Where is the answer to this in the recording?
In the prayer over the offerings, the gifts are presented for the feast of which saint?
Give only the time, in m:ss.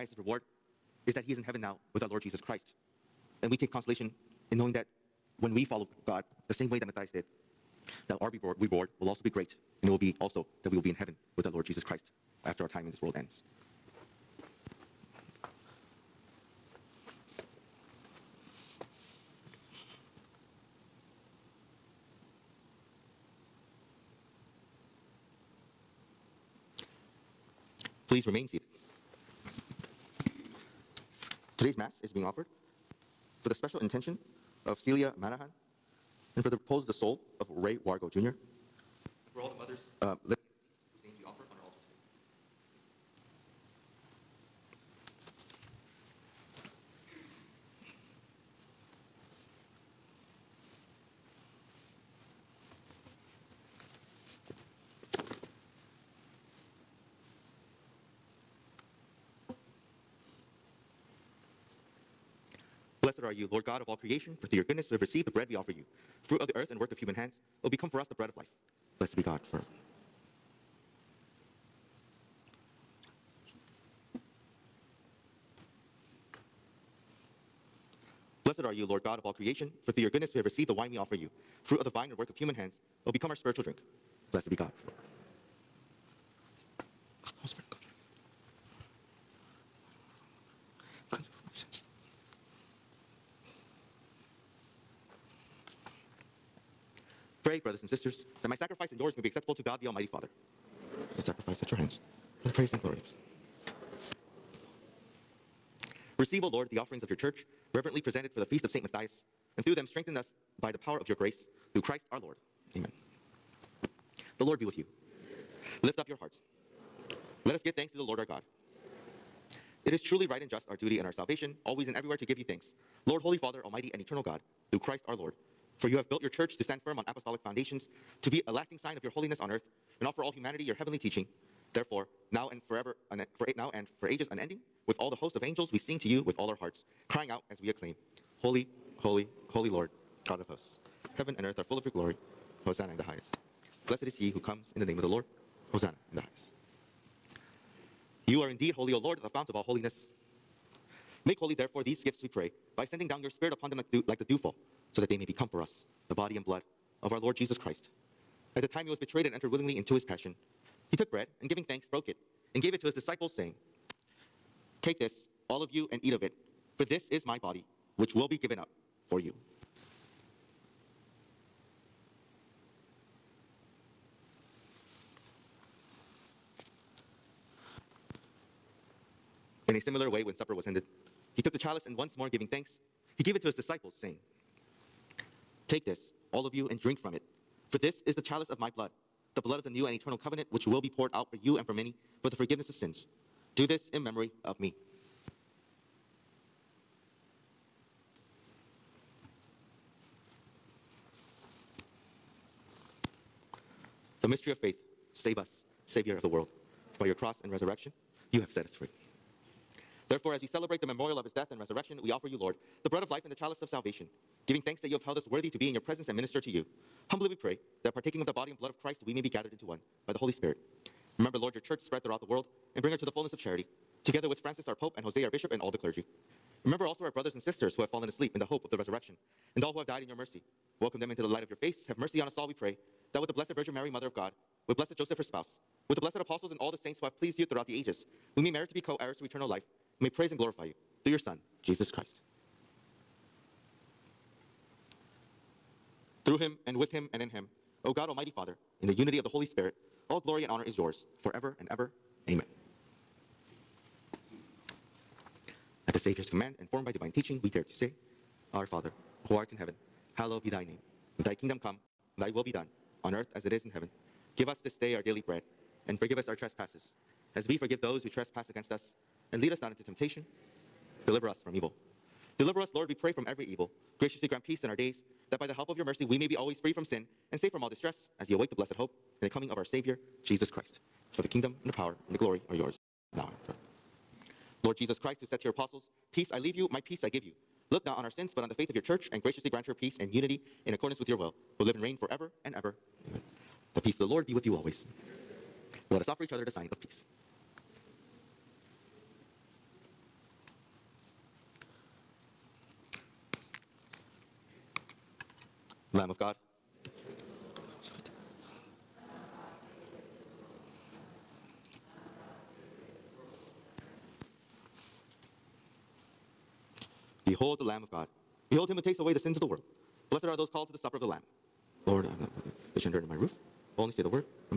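1:48.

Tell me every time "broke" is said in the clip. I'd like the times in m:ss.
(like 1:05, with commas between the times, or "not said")
2:41.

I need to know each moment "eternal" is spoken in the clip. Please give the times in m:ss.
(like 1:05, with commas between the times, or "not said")
2:03, 3:09, 3:59.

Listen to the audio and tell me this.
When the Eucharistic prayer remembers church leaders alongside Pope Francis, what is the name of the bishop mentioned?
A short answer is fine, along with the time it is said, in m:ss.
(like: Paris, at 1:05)
Jose, at 3:45.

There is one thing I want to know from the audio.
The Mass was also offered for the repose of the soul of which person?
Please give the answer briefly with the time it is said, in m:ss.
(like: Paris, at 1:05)
Ray Wargo Jr., at 0:37.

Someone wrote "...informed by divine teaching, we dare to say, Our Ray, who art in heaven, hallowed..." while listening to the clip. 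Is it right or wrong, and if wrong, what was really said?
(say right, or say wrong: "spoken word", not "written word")
wrong: "Father", not "Ray".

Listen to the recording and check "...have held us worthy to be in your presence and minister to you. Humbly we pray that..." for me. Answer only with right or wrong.
right.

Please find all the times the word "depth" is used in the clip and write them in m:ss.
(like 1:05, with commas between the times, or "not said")
not said.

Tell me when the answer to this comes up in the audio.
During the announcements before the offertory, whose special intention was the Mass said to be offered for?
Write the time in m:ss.
0:34.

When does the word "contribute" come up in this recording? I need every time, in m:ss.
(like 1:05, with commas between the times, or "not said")
not said.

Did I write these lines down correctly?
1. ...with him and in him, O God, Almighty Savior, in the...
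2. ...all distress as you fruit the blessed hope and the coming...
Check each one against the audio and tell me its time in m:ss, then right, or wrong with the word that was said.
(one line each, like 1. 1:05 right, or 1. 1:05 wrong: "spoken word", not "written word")
1. 4:06 wrong: "Father", not "Savior"
2. 4:37 wrong: "await", not "fruit".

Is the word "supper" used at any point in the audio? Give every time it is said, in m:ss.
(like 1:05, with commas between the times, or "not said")
3:00, 5:20.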